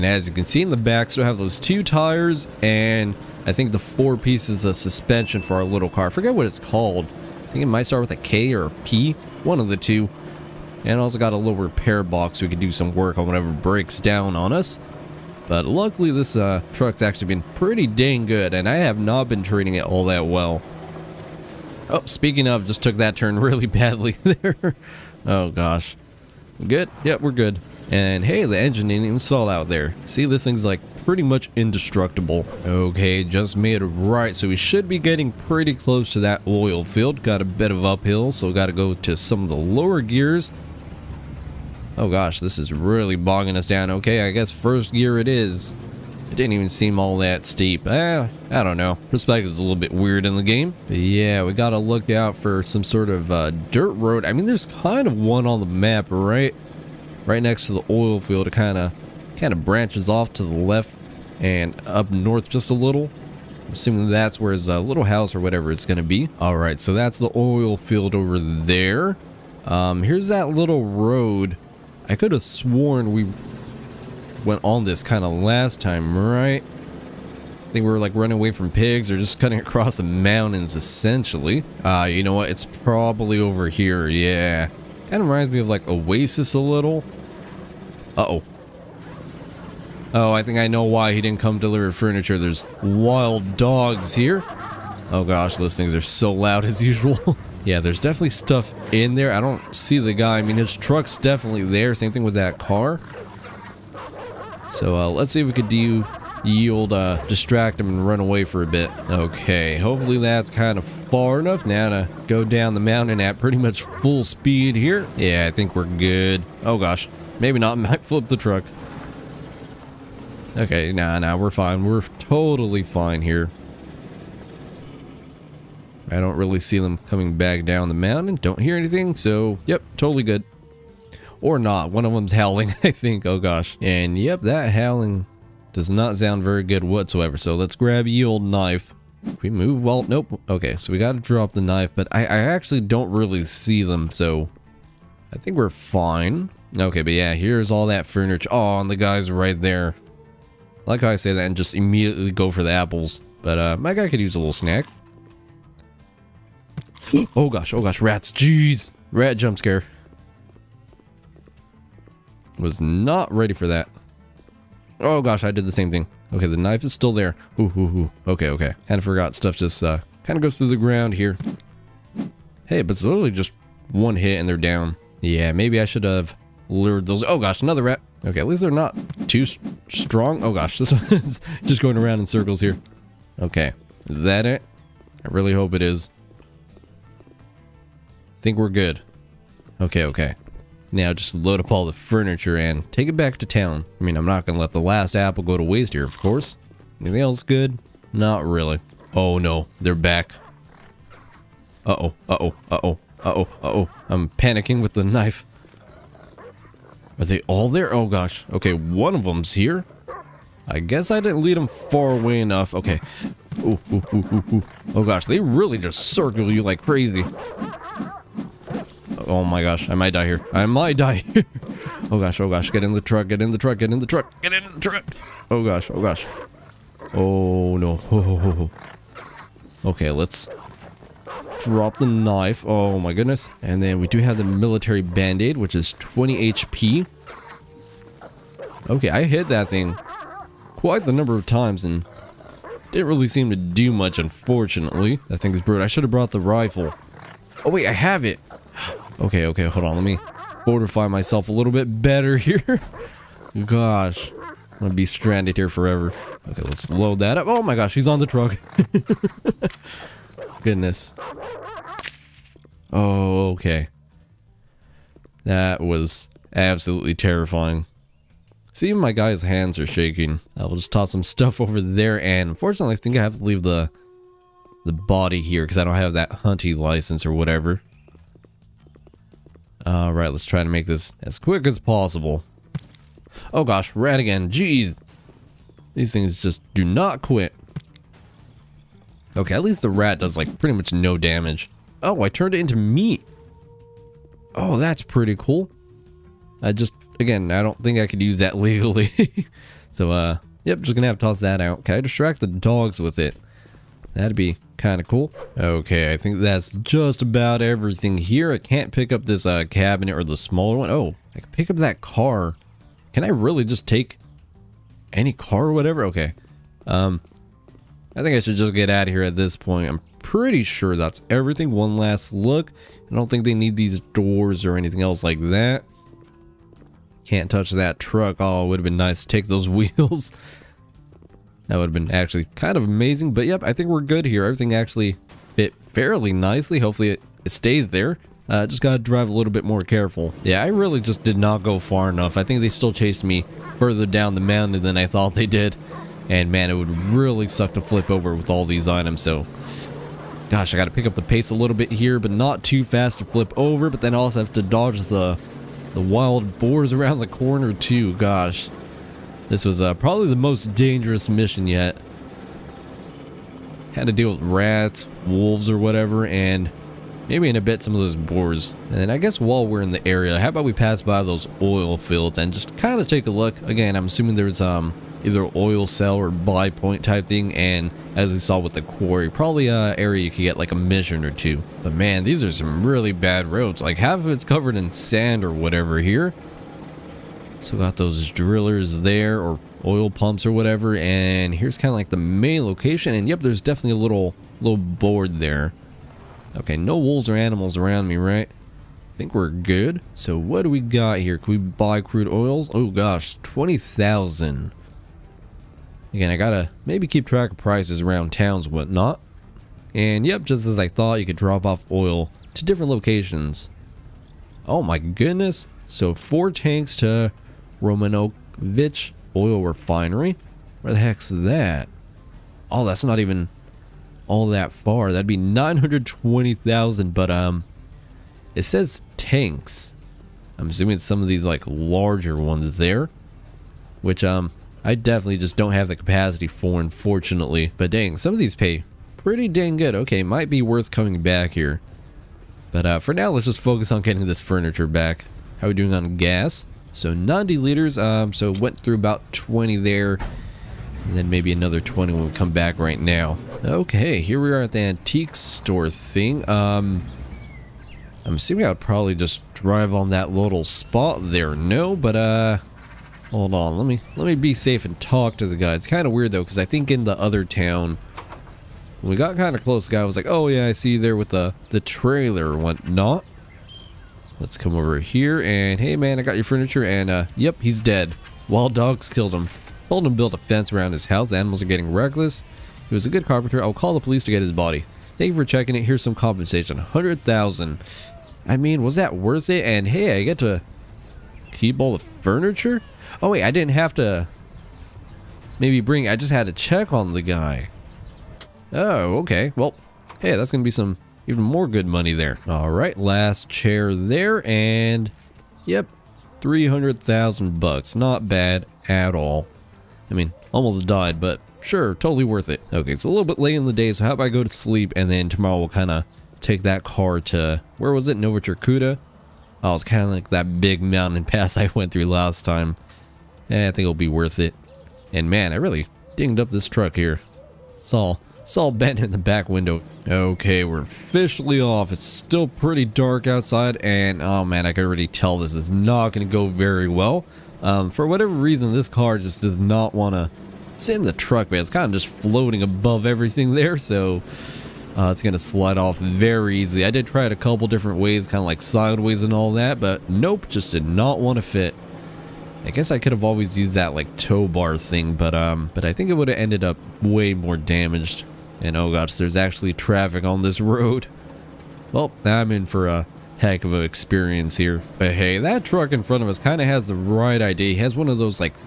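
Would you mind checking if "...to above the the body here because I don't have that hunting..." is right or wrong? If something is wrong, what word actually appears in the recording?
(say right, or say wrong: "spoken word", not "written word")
wrong: "leave", not "above".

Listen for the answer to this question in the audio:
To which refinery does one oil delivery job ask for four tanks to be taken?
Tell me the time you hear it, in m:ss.
6:57.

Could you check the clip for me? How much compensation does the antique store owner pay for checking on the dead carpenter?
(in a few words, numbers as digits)
100,000.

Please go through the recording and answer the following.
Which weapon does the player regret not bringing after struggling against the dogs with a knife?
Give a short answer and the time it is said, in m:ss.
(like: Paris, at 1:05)
Rifle, at 4:06.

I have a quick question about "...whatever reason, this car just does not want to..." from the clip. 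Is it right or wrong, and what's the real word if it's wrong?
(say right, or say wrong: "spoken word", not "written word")
right.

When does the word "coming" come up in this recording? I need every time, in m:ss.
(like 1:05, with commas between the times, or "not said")
2:07, 7:20.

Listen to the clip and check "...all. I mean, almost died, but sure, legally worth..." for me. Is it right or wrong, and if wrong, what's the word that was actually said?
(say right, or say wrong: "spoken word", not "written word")
wrong: "totally", not "legally".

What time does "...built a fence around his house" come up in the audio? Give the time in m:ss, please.
8:00.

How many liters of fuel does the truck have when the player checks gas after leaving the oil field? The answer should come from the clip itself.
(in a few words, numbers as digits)
90.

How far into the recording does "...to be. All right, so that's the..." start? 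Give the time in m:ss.
1:05.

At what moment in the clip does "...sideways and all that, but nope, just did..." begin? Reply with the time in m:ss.
9:08.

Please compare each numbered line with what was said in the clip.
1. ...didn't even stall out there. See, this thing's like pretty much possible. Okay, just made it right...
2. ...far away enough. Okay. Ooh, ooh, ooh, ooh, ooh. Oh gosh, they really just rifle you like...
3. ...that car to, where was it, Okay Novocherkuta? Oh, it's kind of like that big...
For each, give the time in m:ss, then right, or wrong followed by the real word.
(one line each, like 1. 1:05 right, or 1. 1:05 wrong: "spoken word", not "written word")
1. 0:28 wrong: "indestructible", not "possible"
2. 3:31 wrong: "circle", not "rifle"
3. 8:36 wrong: "Nova", not "Okay".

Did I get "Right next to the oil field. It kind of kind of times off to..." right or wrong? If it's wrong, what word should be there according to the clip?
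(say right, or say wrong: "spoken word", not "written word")
wrong: "branches", not "times".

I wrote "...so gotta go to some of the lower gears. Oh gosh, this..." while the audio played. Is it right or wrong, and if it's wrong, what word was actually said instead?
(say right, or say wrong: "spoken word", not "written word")
right.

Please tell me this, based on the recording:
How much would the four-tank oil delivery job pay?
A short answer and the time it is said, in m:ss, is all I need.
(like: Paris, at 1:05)
920,000, at 7:05.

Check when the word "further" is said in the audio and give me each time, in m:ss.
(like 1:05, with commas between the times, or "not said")
5:43.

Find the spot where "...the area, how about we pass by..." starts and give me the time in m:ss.
6:09.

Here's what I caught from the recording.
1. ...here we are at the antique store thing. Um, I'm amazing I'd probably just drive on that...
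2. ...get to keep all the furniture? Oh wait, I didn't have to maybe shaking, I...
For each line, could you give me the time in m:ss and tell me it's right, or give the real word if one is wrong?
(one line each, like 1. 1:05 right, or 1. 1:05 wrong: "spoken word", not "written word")
1. 7:34 wrong: "assuming", not "amazing"
2. 8:10 wrong: "bring", not "shaking".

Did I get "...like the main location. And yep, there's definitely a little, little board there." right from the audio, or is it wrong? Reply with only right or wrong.
right.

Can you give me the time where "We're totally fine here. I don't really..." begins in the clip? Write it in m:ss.
2:01.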